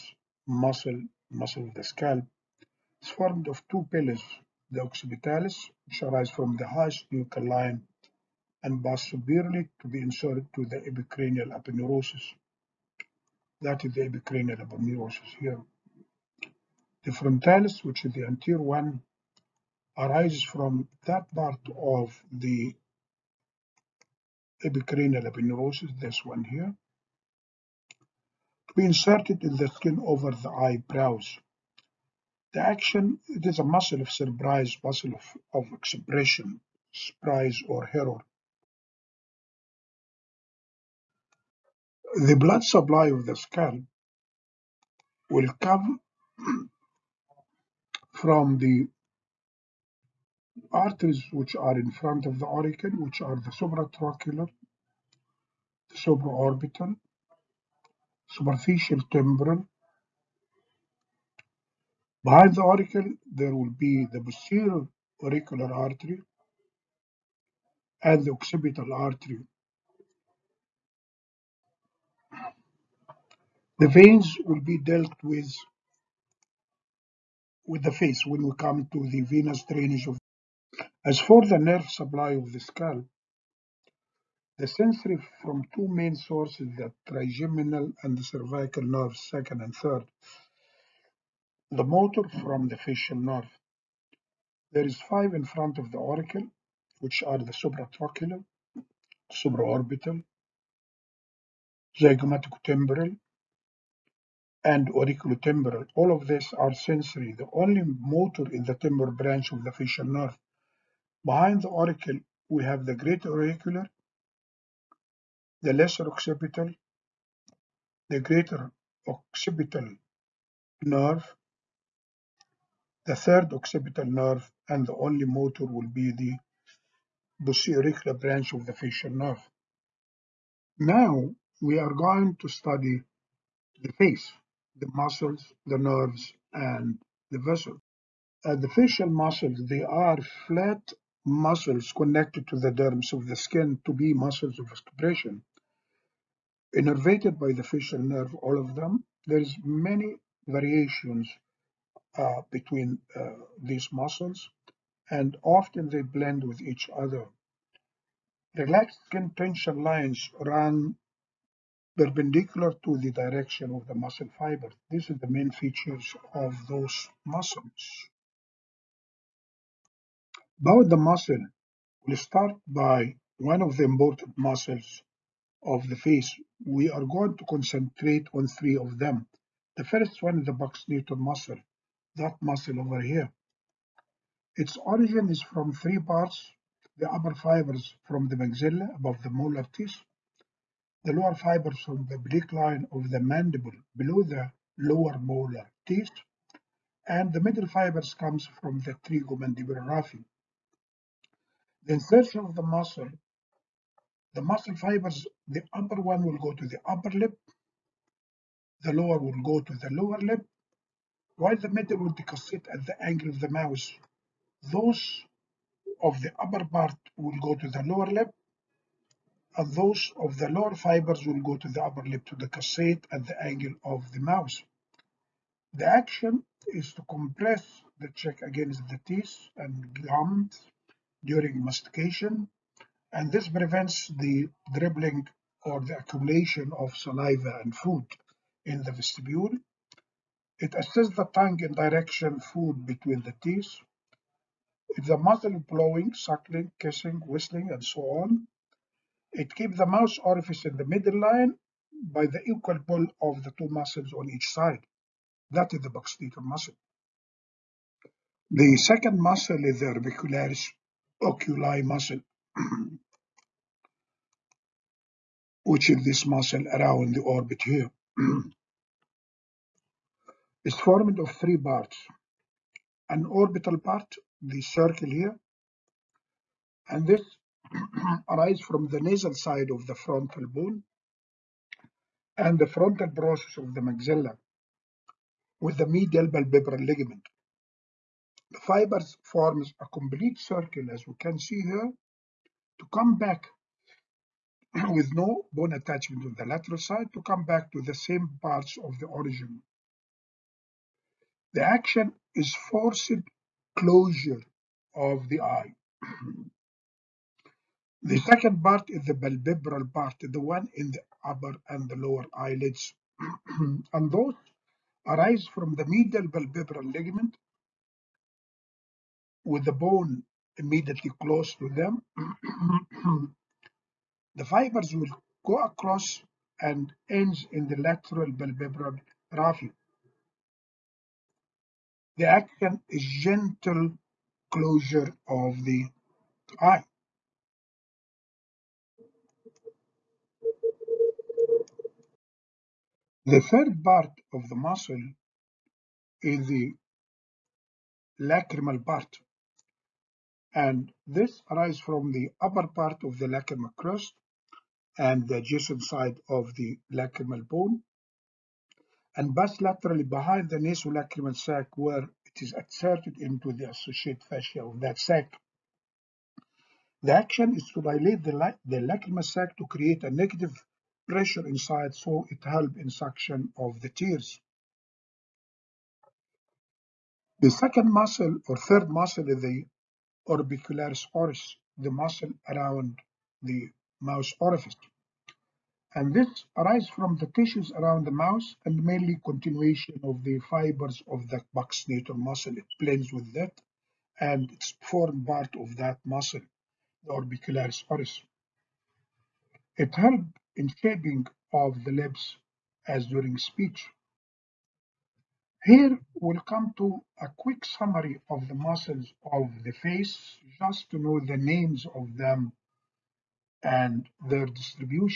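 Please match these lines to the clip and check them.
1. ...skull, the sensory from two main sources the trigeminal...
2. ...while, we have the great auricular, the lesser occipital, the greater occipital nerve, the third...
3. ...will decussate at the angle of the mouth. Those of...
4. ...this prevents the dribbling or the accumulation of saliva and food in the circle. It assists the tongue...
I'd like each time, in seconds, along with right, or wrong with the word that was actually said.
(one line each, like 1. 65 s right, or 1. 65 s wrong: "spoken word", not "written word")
1. 82 s right
2. 111 s wrong: "auricle", not "while"
3. 211 s right
4. 233 s wrong: "vestibule", not "circle".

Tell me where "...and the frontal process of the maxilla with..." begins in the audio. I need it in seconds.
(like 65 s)
282 s.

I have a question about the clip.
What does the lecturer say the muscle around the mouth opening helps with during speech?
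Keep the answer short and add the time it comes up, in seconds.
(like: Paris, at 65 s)
Shaping of the lips, at 400 s.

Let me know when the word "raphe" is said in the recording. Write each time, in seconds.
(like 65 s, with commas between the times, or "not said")
199 s, 329 s.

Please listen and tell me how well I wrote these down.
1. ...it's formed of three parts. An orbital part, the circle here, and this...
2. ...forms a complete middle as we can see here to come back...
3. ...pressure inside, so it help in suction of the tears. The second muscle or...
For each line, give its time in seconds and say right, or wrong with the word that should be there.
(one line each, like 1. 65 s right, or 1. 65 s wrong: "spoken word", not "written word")
1. 270 s right
2. 289 s wrong: "circle", not "middle"
3. 371 s right.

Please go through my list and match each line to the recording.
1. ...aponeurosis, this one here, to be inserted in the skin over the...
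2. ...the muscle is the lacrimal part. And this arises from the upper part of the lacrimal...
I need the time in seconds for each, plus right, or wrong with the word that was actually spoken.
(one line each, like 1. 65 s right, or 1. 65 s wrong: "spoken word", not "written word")
1. 25 s right
2. 344 s right.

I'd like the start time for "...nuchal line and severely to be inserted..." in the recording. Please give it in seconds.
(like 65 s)
7 s.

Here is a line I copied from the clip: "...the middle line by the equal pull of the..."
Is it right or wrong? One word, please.
right.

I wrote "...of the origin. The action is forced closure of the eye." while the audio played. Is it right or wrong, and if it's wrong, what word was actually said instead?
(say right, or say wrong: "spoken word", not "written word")
right.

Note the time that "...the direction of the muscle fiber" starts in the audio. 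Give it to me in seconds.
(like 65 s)
162 s.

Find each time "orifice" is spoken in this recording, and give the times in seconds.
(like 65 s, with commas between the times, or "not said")
250 s, 384 s.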